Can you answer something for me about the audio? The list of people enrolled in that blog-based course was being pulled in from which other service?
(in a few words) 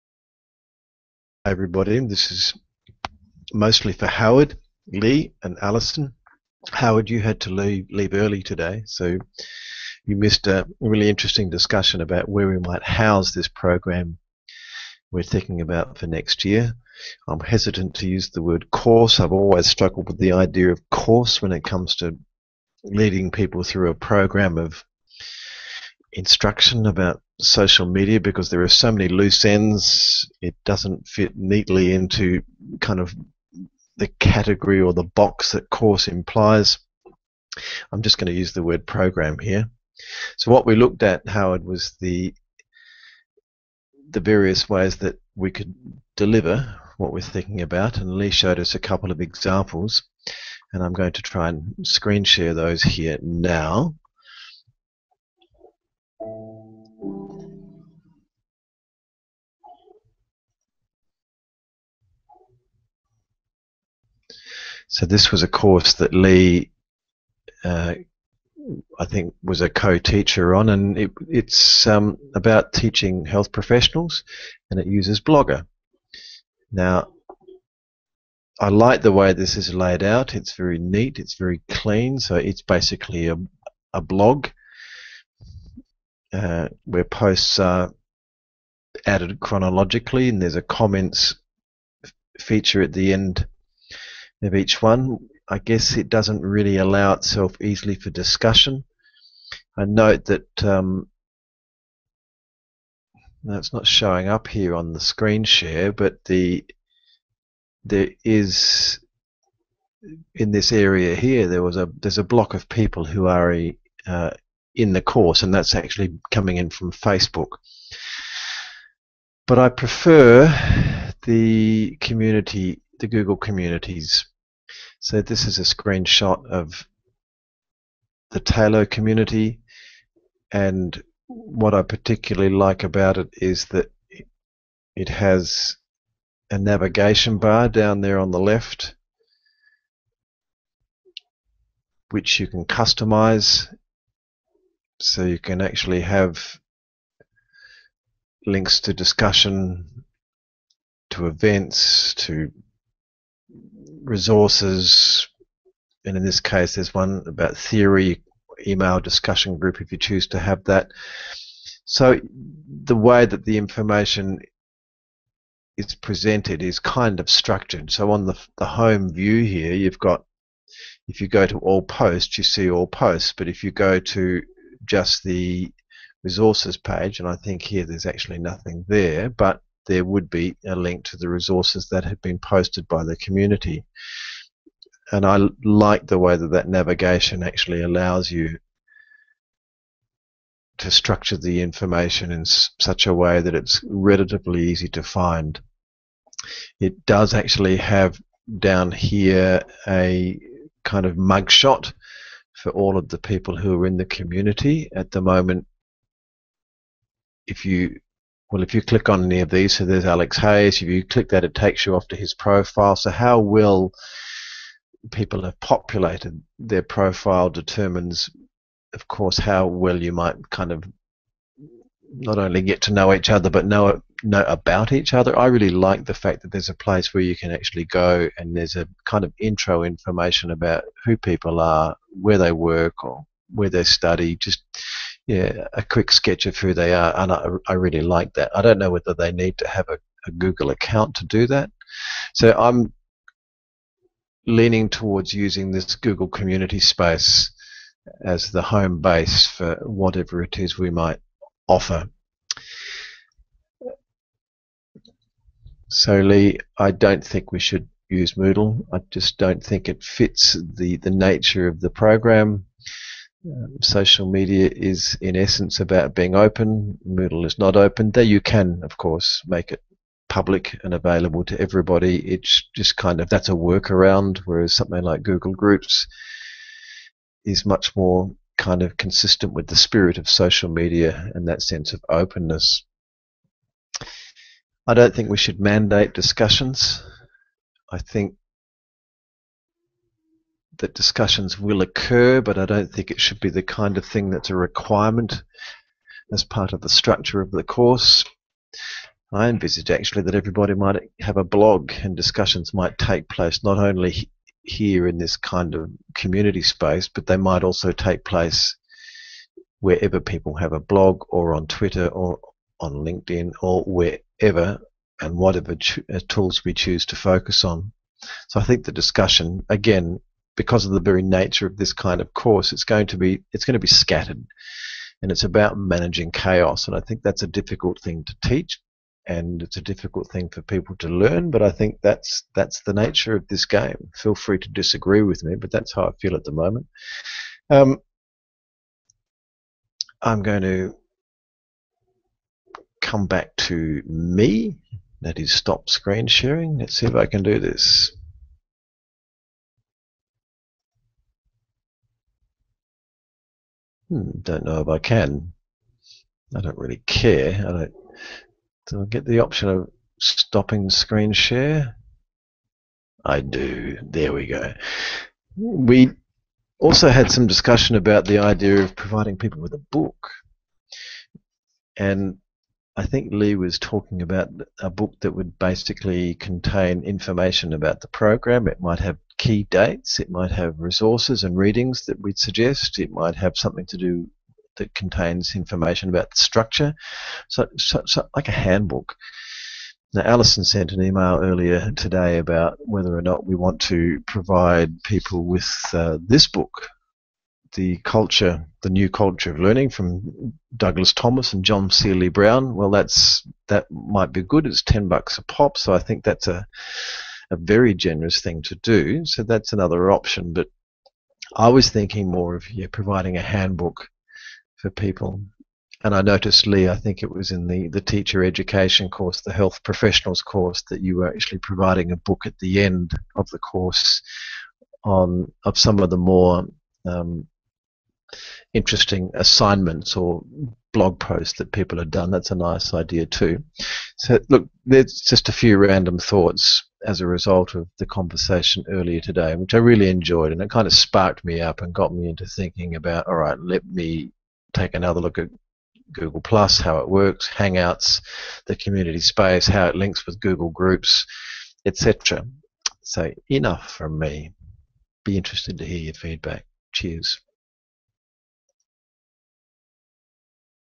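Facebook.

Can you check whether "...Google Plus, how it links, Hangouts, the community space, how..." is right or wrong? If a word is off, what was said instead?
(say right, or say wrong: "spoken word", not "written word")
wrong: "works", not "links".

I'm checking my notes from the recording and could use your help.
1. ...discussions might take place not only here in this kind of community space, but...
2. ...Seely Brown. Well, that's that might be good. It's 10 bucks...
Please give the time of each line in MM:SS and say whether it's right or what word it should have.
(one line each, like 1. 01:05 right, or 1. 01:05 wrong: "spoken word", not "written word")
1. 05:02 right
2. 06:41 right.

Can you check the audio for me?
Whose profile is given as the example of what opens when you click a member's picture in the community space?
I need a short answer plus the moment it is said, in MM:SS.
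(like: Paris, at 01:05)
Alex Hayes, at 03:30.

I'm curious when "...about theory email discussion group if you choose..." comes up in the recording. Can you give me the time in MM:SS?
02:37.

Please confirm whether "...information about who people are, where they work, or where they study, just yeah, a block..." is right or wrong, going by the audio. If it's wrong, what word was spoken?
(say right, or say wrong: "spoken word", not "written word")
wrong: "quick", not "block".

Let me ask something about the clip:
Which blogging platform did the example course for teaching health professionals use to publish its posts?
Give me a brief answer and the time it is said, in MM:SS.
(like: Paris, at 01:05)
Blogger, at 01:15.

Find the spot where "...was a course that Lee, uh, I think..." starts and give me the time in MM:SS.
01:05.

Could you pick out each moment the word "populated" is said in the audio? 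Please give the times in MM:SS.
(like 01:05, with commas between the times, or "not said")
03:35.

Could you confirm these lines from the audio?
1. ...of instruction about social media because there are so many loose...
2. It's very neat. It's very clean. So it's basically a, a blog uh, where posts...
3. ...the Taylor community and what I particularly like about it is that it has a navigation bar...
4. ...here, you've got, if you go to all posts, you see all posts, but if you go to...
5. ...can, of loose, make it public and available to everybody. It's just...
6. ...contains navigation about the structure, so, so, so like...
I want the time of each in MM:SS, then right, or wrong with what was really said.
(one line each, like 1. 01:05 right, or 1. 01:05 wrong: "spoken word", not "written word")
1. 00:24 right
2. 01:20 right
3. 02:08 right
4. 02:49 right
5. 04:28 wrong: "course", not "loose"
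6. 06:24 wrong: "information", not "navigation".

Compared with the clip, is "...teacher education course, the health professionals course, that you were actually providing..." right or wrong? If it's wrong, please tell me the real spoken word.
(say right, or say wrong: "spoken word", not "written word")
right.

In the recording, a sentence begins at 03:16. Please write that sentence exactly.
It does actually have down here a kind of mugshot for all of the people who are in the community.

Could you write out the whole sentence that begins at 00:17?
I'm hesitant to use the word course.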